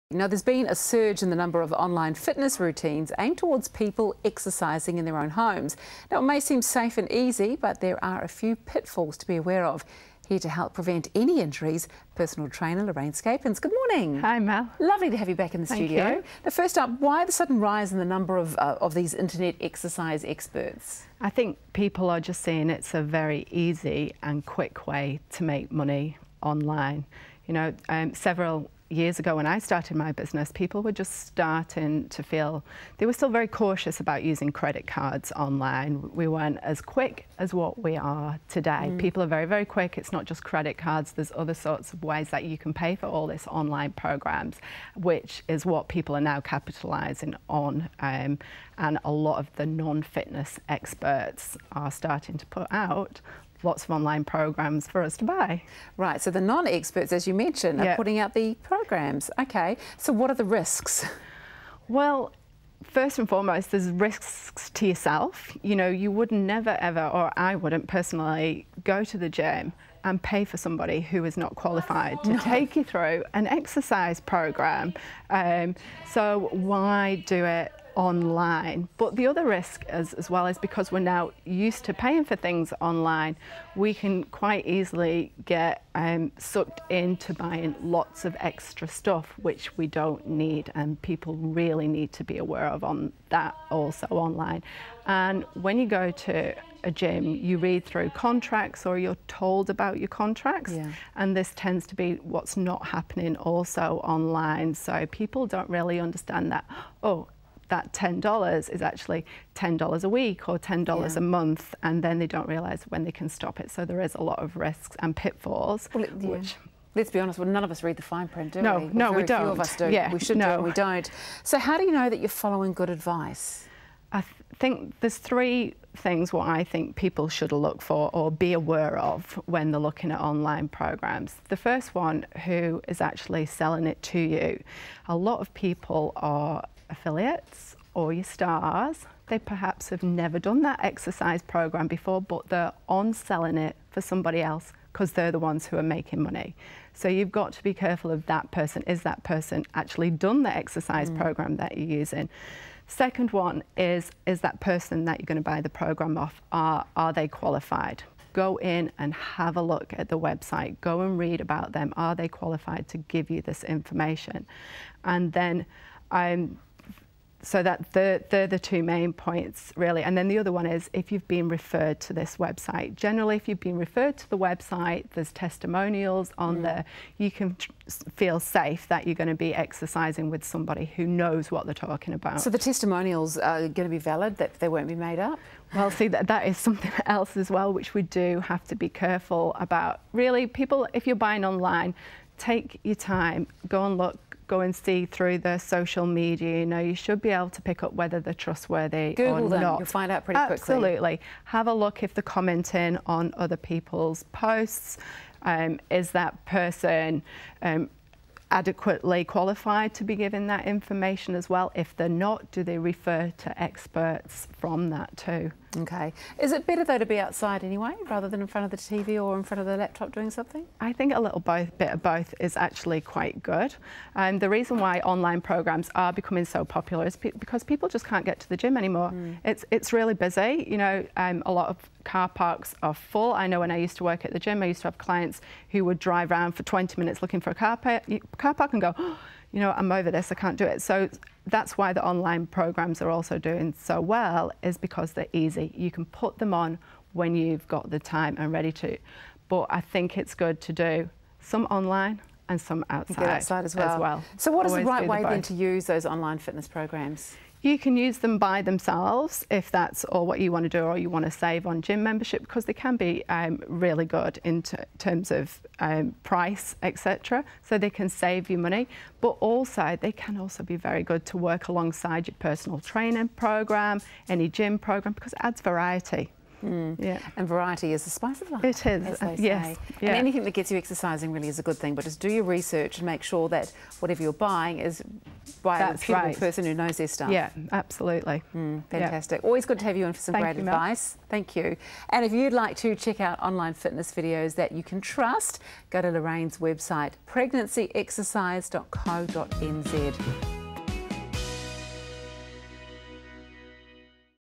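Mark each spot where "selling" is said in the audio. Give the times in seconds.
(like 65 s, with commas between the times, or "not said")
133 s, 143 s.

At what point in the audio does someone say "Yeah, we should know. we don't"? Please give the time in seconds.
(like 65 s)
119 s.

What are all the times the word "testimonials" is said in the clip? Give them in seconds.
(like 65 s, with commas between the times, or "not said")
175 s, 182 s.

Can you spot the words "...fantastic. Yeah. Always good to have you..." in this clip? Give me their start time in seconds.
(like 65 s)
288 s.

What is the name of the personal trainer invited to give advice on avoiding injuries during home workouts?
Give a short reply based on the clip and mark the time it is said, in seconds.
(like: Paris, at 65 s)
Lorraine Scapens, at 12 s.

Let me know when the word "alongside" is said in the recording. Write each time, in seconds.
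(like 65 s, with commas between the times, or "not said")
271 s.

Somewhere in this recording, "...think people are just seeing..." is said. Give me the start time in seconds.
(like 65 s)
21 s.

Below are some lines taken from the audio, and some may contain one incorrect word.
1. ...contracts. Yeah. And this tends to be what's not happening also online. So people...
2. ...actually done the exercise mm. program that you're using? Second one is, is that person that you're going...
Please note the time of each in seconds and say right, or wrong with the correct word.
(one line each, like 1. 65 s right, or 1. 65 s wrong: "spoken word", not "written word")
1. 100 s right
2. 149 s right.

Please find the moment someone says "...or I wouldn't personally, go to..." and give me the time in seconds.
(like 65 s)
67 s.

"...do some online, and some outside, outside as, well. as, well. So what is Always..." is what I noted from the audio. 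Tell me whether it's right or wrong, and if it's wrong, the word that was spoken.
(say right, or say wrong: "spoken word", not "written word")
right.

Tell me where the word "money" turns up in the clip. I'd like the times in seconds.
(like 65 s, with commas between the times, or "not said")
25 s, 146 s, 268 s.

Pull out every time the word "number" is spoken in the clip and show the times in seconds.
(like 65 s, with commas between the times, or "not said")
1 s, 18 s.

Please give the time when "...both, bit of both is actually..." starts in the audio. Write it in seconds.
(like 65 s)
221 s.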